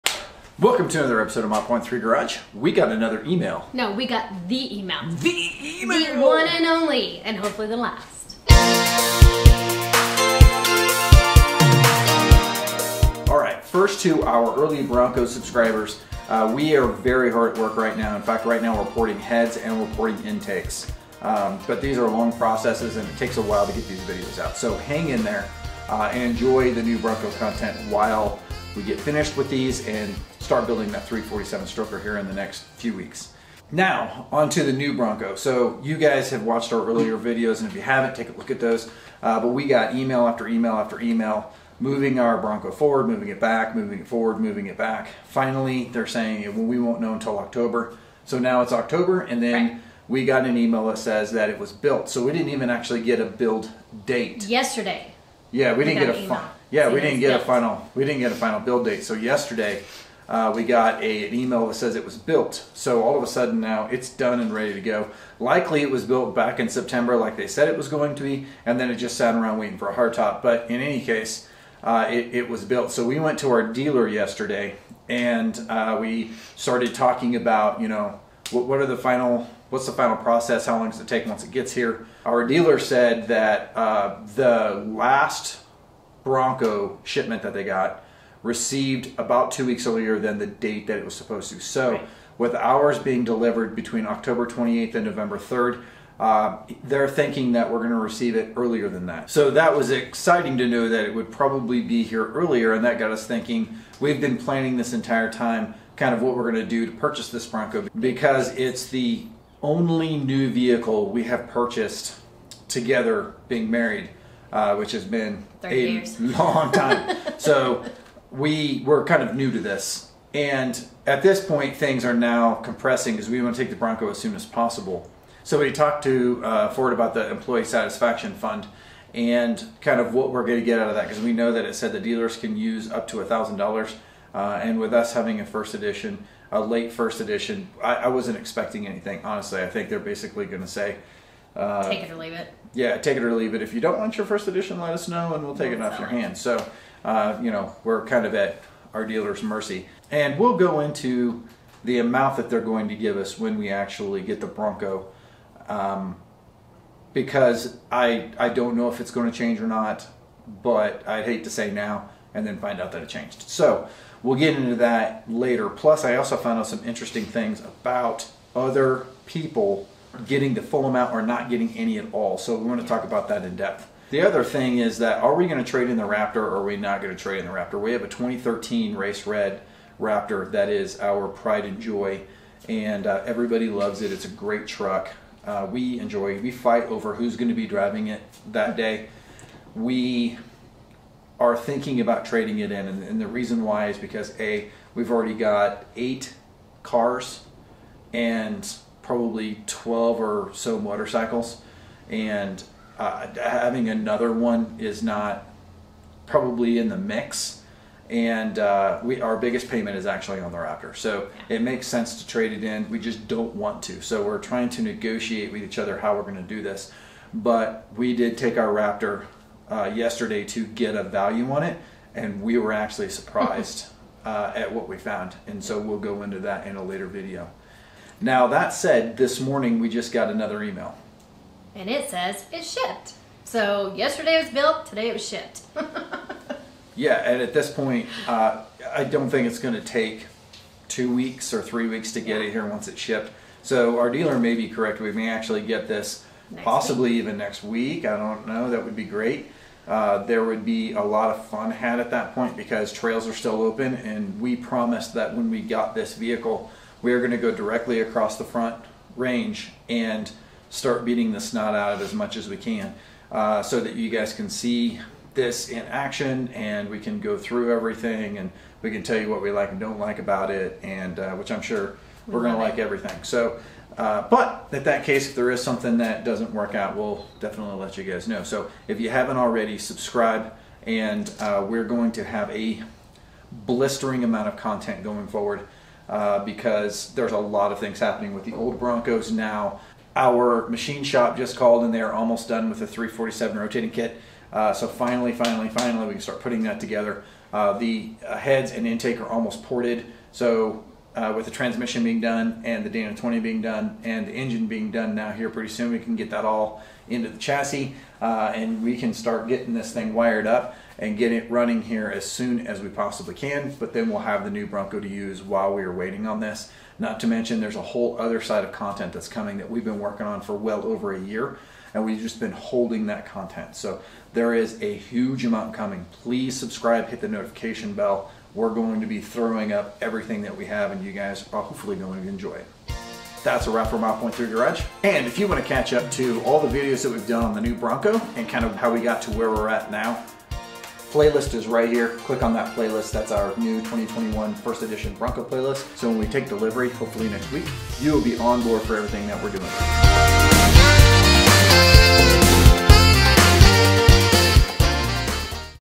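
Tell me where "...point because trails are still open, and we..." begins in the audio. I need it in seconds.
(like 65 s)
252 s.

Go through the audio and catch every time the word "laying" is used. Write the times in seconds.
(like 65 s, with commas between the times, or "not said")
not said.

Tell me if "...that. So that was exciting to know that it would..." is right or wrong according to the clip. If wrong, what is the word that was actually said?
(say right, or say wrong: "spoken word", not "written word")
right.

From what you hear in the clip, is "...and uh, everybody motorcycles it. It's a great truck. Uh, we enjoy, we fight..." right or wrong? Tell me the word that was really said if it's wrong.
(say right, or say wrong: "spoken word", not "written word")
wrong: "loves", not "motorcycles".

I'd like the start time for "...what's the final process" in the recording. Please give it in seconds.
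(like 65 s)
79 s.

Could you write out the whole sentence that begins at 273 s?
So, uh, but in that case, if there is something that doesn't work out, we'll definitely let you guys know.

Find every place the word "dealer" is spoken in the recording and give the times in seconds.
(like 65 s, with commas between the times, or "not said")
73 s, 82 s, 131 s, 149 s, 244 s.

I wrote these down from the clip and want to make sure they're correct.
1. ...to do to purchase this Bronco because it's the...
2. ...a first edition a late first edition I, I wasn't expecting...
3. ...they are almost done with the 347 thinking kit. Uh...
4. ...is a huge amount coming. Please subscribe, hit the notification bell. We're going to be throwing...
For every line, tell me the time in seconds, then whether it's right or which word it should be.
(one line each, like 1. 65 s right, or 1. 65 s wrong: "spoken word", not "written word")
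1. 106 s right
2. 135 s right
3. 291 s wrong: "rotating", not "thinking"
4. 324 s right.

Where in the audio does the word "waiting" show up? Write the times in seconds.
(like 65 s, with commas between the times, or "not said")
69 s, 315 s.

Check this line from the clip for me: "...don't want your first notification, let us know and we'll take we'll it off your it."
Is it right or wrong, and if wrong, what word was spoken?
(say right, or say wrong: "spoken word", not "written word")
wrong: "edition", not "notification".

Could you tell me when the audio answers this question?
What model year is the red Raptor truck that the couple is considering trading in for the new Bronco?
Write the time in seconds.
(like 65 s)
178 s.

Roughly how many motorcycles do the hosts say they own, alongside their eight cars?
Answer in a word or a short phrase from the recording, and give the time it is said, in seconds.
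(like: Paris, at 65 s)
12, at 199 s.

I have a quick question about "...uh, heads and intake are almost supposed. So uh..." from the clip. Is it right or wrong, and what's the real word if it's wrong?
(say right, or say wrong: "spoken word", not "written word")
wrong: "ported", not "supposed".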